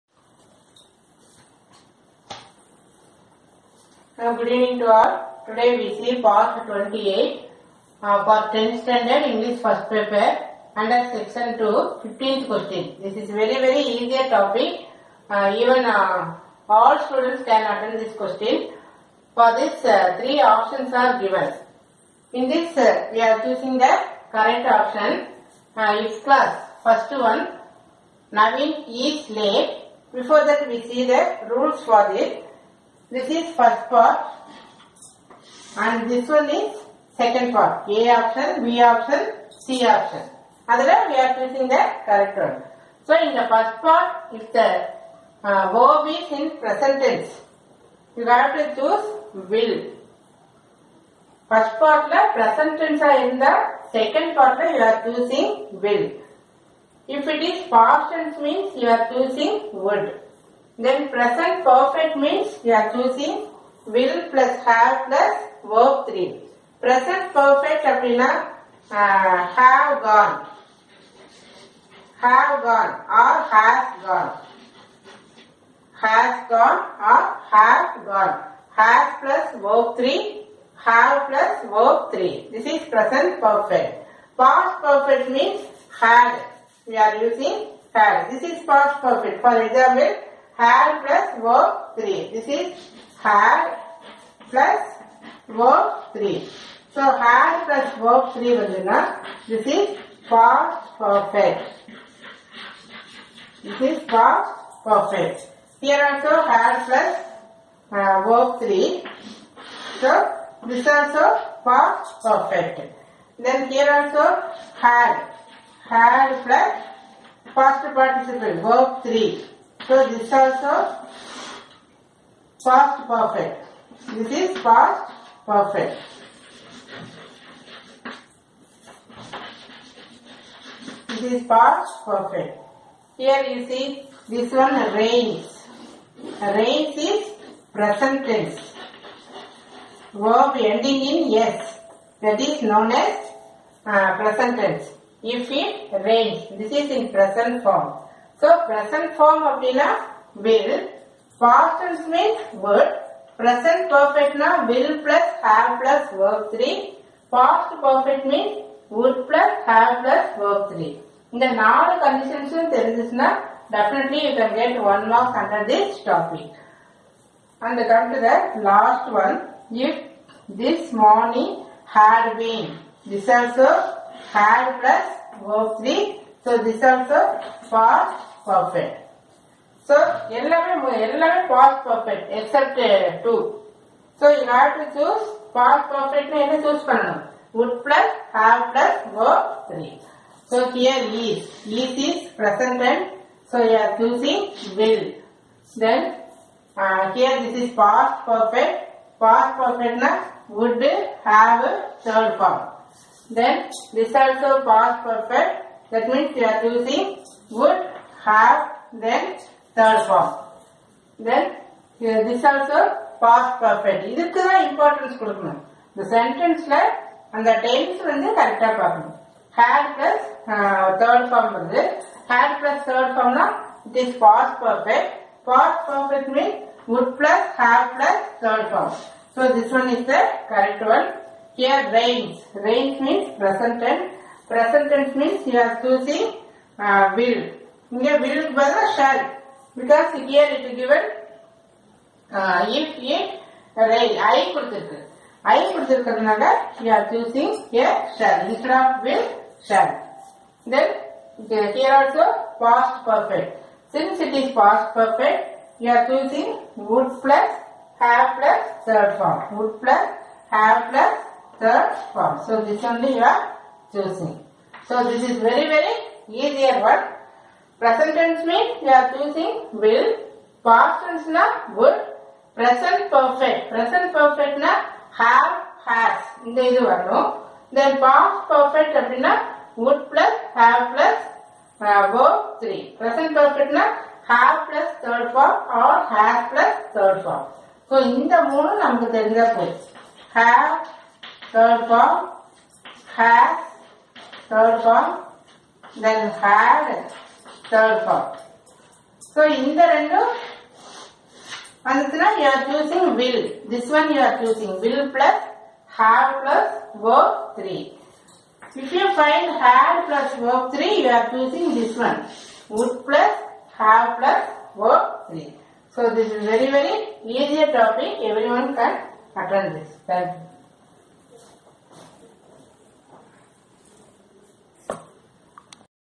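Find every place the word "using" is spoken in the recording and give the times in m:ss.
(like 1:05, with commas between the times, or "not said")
1:27, 4:29.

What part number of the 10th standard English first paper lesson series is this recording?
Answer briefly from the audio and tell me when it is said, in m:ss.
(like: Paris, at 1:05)
28, at 0:06.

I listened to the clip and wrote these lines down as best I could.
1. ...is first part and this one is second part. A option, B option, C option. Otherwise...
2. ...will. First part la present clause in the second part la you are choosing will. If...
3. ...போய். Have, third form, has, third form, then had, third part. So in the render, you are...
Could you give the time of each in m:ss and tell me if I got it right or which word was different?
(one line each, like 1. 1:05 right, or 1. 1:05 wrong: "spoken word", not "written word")
1. 0:33 right
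2. 0:49 wrong: "tense", not "clause"
3. 4:49 right.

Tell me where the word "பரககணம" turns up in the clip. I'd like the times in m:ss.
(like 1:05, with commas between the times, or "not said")
3:38.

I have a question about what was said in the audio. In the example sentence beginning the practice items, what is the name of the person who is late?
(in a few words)
Navin.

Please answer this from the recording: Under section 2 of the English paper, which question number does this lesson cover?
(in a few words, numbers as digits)
15th.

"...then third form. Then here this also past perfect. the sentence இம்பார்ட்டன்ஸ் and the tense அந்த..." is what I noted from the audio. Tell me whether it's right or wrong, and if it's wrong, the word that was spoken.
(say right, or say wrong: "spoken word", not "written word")
right.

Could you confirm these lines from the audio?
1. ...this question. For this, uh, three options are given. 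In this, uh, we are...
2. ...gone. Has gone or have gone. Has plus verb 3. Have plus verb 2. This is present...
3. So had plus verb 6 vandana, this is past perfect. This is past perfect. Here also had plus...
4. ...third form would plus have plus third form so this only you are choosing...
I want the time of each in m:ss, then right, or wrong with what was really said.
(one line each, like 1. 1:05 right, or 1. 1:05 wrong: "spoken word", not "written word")
1. 0:17 right
2. 1:14 wrong: "3", not "2"
3. 1:36 wrong: "3", not "6"
4. 4:18 right.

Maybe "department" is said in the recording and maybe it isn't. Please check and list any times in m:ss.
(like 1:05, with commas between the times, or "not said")
not said.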